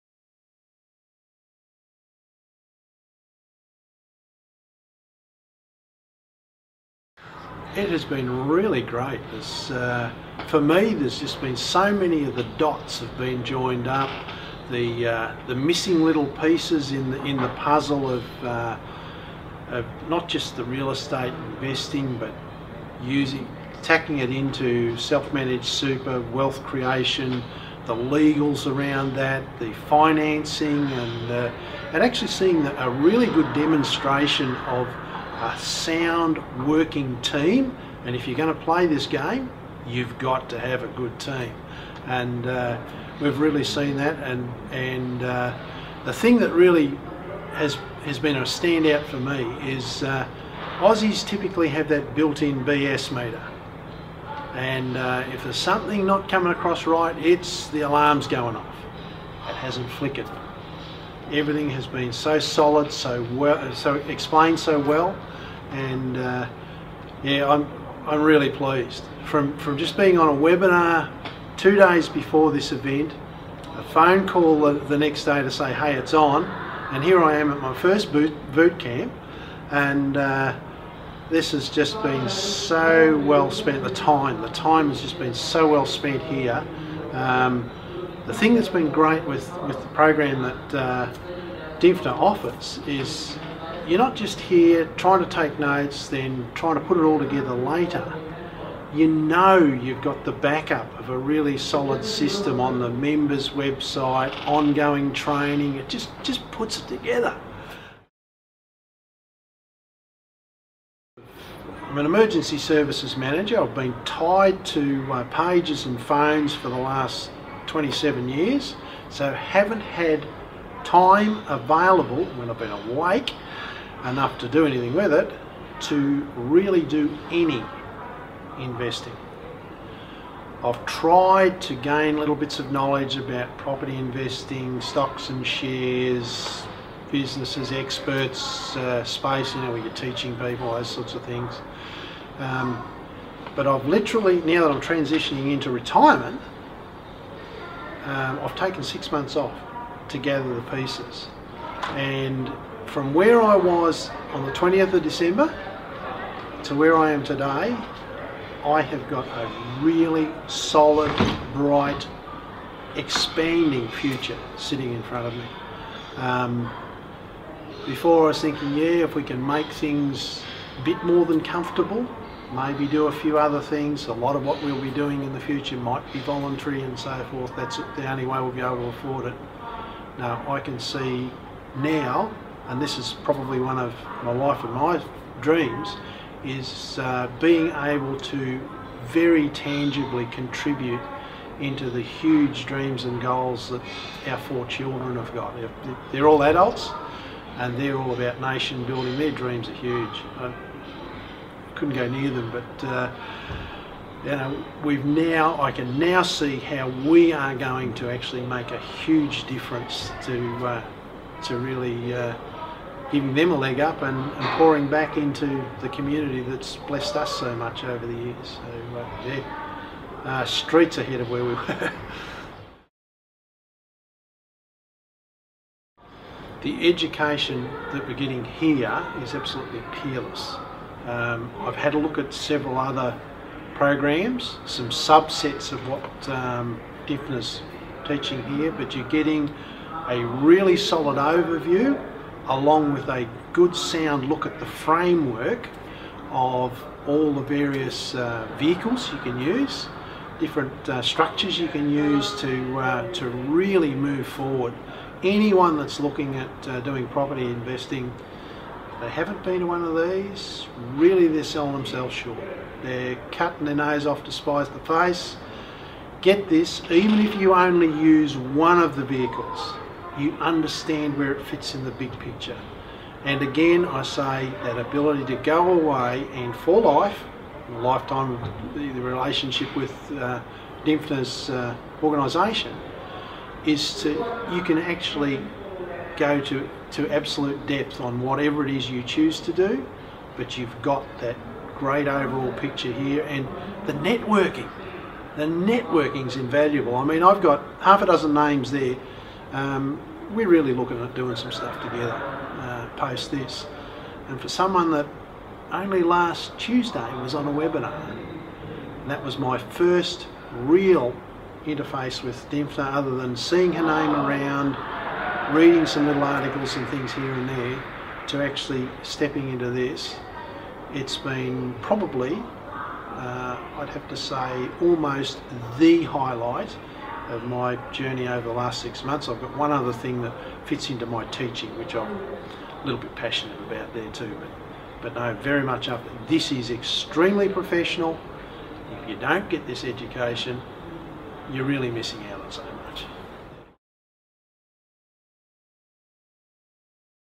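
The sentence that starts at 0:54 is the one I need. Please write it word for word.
And uh, if there's something not coming across right, it's the alarm's going off.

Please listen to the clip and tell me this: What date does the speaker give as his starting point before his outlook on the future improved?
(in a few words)
20th of December.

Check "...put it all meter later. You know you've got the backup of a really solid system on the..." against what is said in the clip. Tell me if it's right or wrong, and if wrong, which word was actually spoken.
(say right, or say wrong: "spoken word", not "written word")
wrong: "together", not "meter".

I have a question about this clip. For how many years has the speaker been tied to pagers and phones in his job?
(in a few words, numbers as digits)
27.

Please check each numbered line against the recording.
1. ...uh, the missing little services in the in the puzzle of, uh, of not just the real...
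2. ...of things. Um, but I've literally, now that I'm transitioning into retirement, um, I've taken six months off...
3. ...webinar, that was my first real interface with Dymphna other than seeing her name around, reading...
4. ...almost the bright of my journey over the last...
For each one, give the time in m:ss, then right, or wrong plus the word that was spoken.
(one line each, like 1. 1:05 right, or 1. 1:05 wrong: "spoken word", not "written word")
1. 0:15 wrong: "pieces", not "services"
2. 2:21 right
3. 5:07 right
4. 5:24 wrong: "highlight", not "bright".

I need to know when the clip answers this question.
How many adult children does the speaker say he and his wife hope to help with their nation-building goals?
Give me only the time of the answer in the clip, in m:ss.
3:14.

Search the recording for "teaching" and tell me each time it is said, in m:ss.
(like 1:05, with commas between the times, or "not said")
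2:19, 3:58, 5:31.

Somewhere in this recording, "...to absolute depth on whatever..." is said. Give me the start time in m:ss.
4:46.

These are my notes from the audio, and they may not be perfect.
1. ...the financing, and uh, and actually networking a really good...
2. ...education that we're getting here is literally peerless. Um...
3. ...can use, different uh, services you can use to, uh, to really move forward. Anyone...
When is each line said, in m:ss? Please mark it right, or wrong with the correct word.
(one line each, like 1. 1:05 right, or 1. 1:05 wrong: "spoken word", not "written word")
1. 0:29 wrong: "seeing", not "networking"
2. 3:46 wrong: "absolutely", not "literally"
3. 4:09 wrong: "structures", not "services".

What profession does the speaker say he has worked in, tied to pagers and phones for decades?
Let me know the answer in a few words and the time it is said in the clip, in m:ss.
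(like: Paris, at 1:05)
Emergency services manager, at 1:52.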